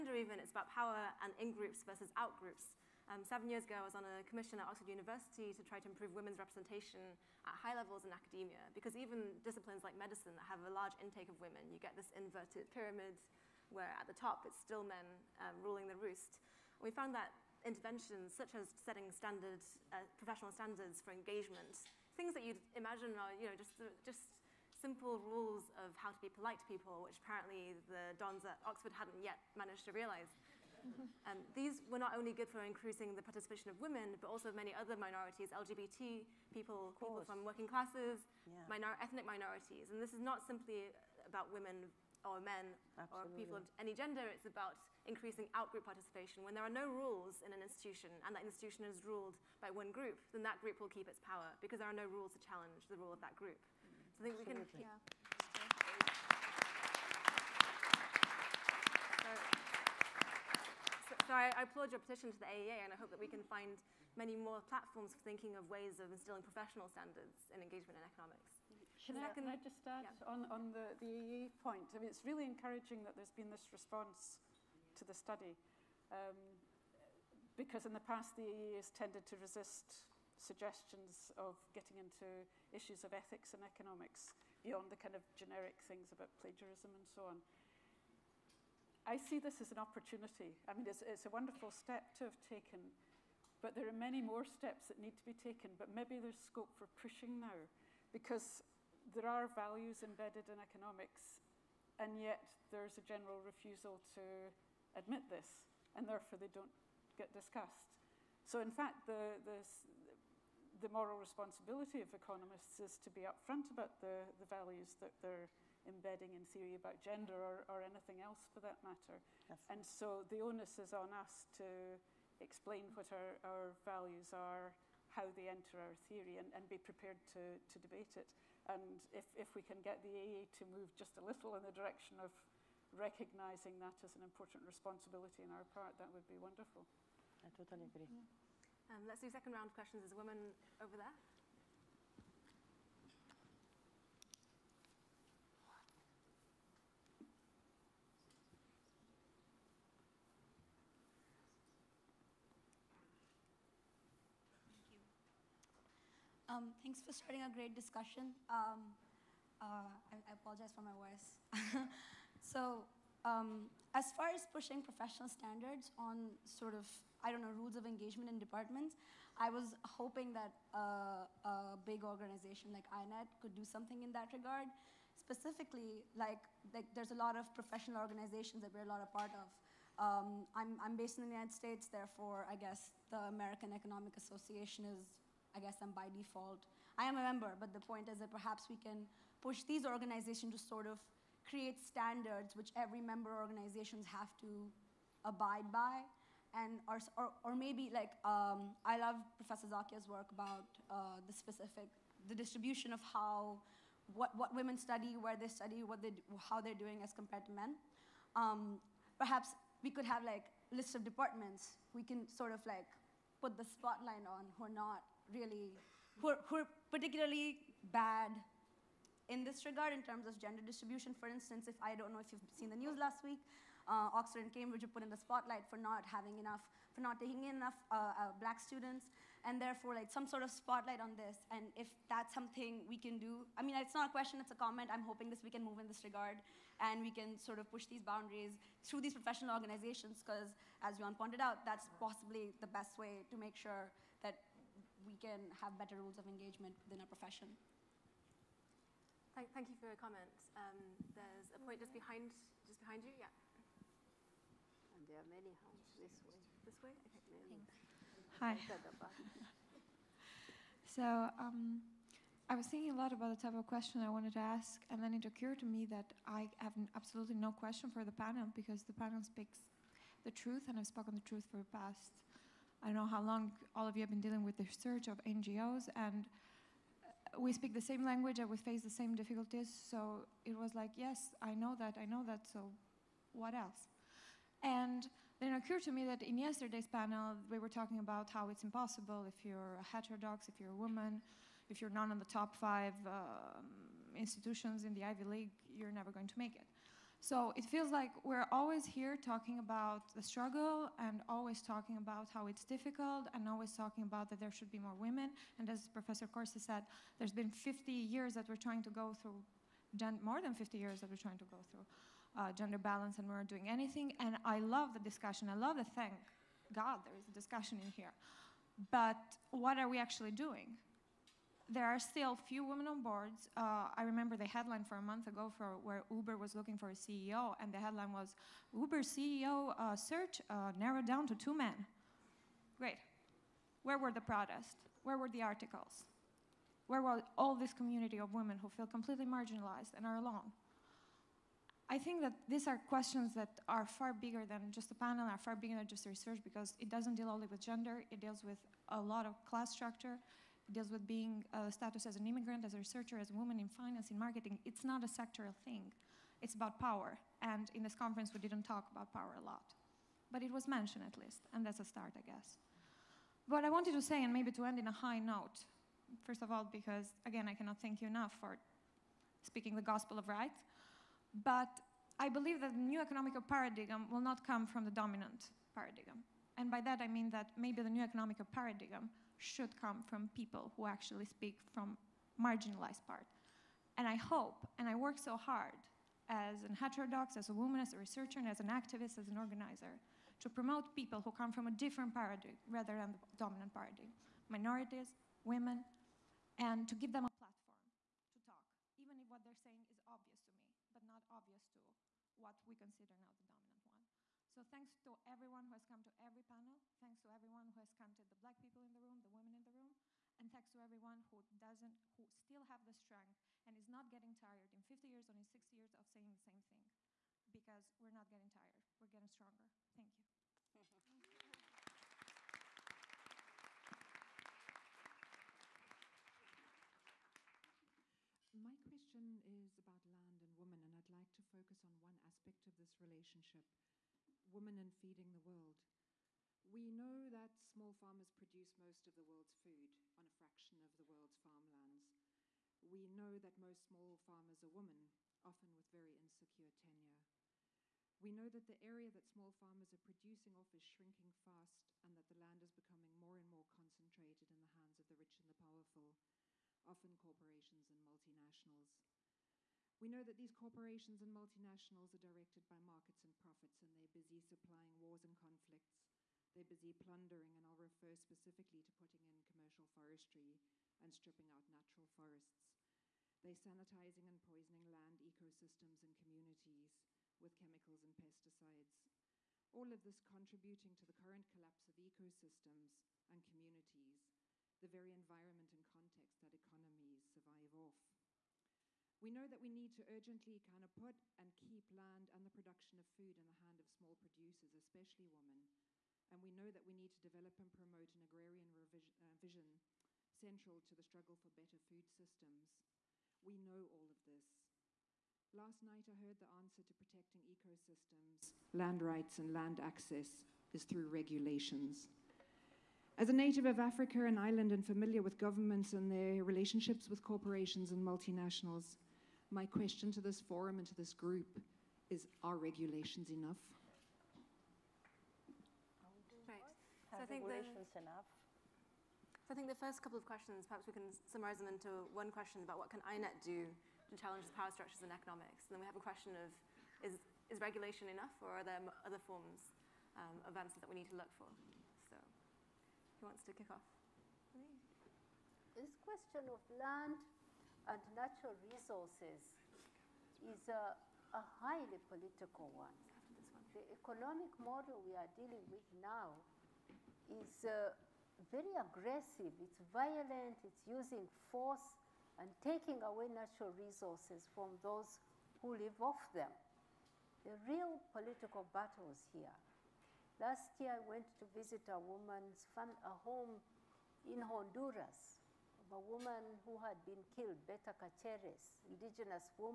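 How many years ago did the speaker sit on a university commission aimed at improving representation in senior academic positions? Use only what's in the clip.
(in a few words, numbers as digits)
7.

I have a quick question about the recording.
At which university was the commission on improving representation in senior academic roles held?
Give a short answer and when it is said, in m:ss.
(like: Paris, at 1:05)
Oxford University, at 0:04.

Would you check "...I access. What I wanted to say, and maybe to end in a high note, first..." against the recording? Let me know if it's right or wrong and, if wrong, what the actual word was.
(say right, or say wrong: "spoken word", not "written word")
wrong: "guess", not "access".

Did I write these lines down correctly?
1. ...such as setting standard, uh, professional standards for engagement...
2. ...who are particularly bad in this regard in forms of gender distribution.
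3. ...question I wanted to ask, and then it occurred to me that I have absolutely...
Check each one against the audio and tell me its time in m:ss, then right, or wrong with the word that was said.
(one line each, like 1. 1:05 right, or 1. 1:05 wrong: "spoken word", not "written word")
1. 0:18 right
2. 3:36 wrong: "terms", not "forms"
3. 4:23 right.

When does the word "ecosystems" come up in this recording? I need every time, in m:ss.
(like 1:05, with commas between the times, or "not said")
7:55, 8:01, 8:27.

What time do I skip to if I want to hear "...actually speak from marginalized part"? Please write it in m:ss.
6:20.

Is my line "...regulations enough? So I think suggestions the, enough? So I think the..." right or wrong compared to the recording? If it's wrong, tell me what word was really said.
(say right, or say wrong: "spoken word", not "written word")
wrong: "regulations", not "suggestions".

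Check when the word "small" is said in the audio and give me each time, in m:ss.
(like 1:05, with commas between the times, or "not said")
7:17, 7:23, 7:29, 8:13.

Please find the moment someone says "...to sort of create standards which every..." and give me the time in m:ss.
3:10.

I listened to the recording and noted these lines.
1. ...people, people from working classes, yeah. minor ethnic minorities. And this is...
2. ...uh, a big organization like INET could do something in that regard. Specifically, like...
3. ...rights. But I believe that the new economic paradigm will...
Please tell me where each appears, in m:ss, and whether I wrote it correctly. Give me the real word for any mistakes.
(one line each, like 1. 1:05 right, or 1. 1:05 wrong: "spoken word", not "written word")
1. 0:36 right
2. 2:50 right
3. 6:10 right.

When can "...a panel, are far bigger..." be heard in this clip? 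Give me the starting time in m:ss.
5:44.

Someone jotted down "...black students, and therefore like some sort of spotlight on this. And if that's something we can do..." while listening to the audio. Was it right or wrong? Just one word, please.
right.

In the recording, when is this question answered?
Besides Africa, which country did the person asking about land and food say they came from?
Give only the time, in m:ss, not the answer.
8:34.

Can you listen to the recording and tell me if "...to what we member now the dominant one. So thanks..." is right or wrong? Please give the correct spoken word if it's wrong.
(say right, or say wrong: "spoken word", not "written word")
wrong: "consider", not "member".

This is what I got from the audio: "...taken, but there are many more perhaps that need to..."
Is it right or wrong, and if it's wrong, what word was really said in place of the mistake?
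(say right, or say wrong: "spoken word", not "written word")
wrong: "steps", not "perhaps".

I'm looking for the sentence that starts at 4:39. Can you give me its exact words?
So it was like, yes, I know that, I know that.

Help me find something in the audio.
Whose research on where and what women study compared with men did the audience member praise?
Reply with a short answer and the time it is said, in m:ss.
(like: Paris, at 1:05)
Professor Zacchia, at 3:19.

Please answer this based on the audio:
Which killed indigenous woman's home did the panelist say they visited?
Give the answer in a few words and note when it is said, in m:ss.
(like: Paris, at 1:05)
Berta Caceres, at 9:37.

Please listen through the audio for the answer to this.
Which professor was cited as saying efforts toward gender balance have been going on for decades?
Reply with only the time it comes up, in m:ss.
5:05.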